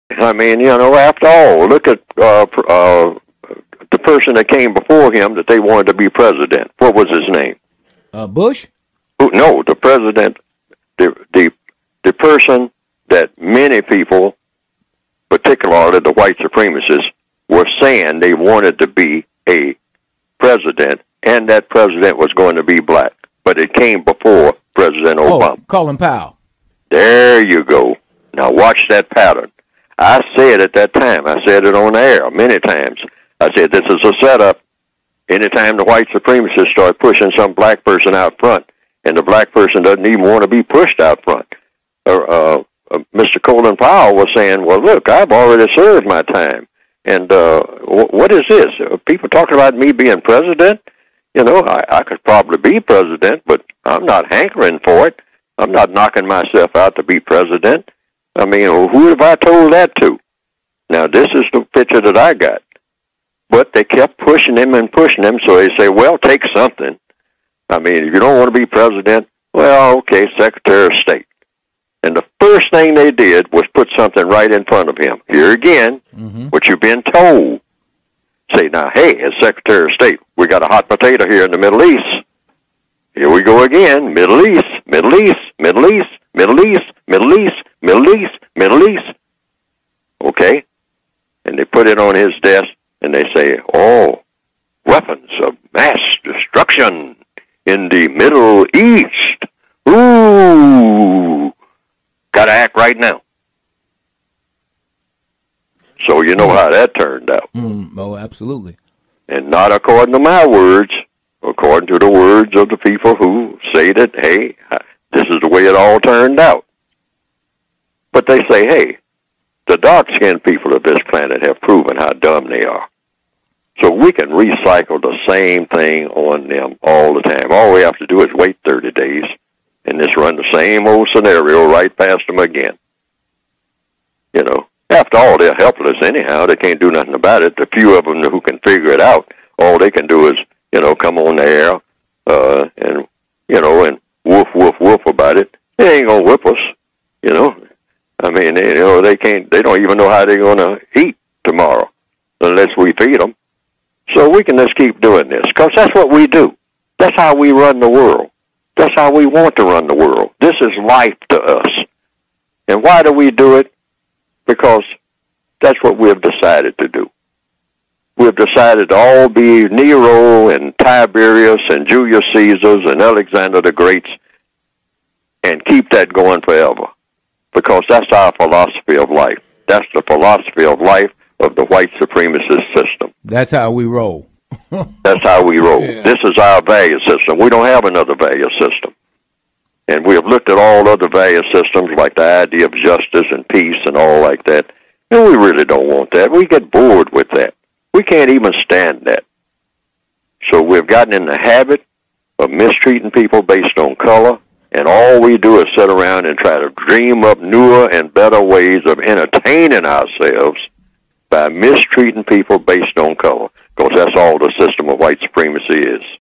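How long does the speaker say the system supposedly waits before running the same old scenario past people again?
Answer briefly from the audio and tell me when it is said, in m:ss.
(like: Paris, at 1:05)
30 days, at 2:08.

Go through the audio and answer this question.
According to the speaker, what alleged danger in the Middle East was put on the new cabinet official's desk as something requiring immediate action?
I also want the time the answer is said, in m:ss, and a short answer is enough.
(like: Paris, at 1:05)
weapons of mass destruction, at 1:34.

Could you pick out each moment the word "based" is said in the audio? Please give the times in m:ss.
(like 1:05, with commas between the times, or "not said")
3:23, 3:32.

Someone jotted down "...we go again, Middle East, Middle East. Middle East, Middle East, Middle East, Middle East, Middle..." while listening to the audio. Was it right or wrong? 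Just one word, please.
right.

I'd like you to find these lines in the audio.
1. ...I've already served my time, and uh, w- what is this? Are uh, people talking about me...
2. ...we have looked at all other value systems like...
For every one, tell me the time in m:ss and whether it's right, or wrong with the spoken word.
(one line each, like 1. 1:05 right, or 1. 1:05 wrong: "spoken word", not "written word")
1. 0:45 right
2. 3:10 right.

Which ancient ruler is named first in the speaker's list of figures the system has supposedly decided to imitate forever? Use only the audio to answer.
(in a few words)
Nero.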